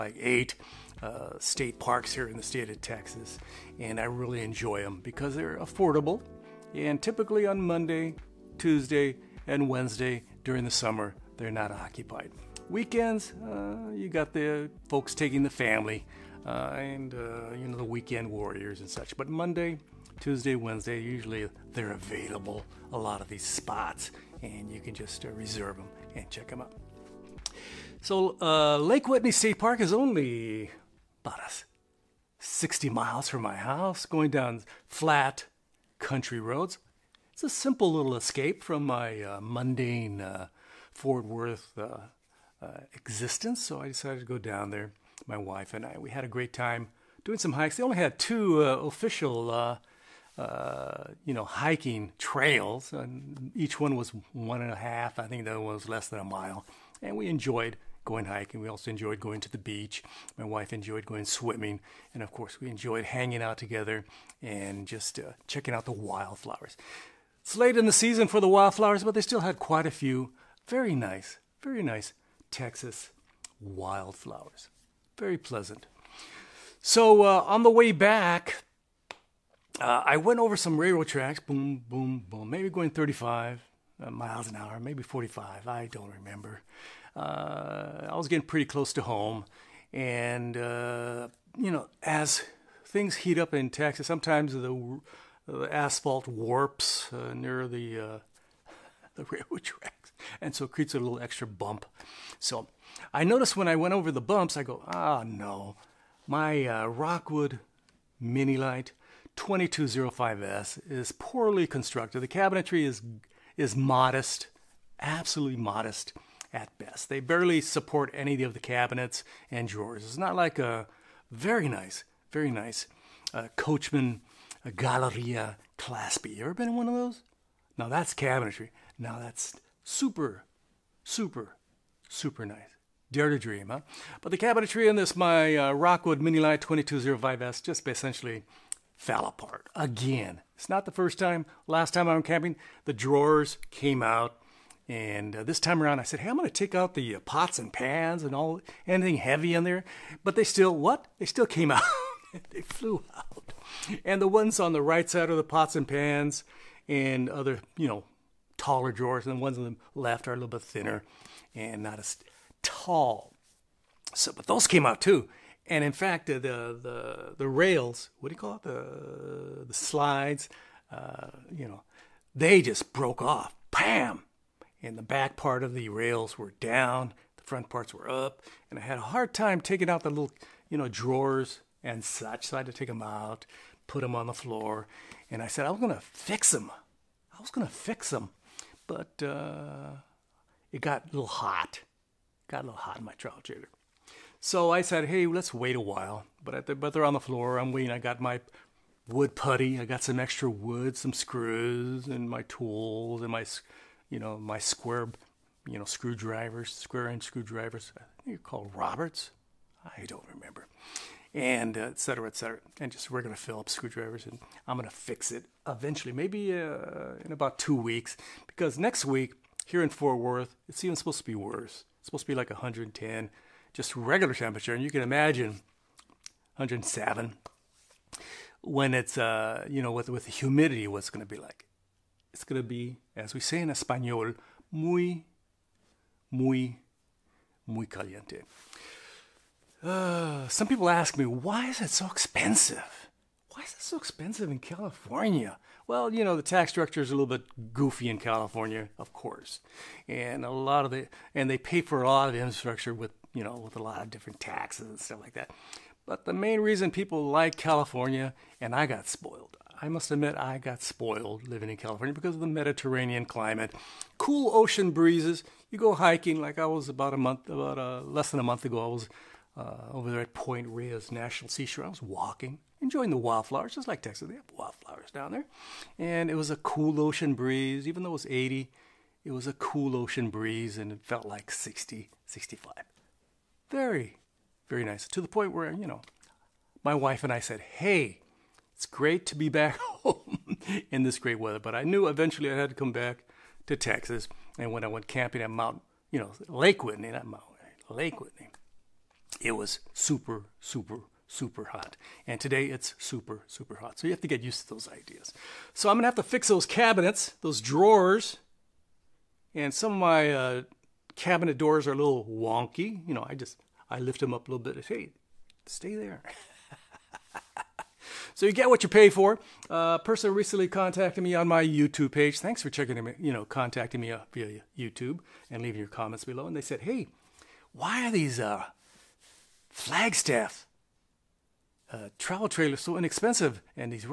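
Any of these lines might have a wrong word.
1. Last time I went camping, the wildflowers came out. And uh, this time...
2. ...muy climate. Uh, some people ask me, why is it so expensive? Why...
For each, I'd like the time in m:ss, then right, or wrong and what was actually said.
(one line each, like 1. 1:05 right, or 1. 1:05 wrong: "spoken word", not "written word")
1. 2:21 wrong: "drawers", not "wildflowers"
2. 3:57 wrong: "caliente", not "climate".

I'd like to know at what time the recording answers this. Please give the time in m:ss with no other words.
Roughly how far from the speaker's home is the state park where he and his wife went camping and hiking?
0:32.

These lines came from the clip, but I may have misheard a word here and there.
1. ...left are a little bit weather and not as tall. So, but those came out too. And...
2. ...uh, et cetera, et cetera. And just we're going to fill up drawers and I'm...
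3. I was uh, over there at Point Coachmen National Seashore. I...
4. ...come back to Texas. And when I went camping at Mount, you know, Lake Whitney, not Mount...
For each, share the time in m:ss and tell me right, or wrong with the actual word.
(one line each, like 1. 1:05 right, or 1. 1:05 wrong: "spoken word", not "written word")
1. 2:39 wrong: "thinner", not "weather"
2. 3:31 wrong: "screwdrivers", not "drawers"
3. 4:28 wrong: "Reyes", not "Coachmen"
4. 4:52 right.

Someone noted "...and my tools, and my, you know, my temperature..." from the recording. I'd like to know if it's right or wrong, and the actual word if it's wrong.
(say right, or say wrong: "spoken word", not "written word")
wrong: "square", not "temperature".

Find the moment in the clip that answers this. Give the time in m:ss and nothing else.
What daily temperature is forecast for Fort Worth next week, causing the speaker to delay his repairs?
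3:42.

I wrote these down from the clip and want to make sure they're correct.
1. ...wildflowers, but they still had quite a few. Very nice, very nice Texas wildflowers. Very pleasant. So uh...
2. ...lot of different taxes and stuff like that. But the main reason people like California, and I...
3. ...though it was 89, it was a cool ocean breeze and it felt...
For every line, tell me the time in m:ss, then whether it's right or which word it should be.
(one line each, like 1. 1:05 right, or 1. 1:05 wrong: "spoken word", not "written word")
1. 1:08 right
2. 4:13 right
3. 4:38 wrong: "80", not "89".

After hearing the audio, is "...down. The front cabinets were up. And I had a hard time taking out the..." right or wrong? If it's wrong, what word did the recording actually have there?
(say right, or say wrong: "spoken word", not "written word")
wrong: "parts", not "cabinets".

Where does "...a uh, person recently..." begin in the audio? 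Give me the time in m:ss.
5:19.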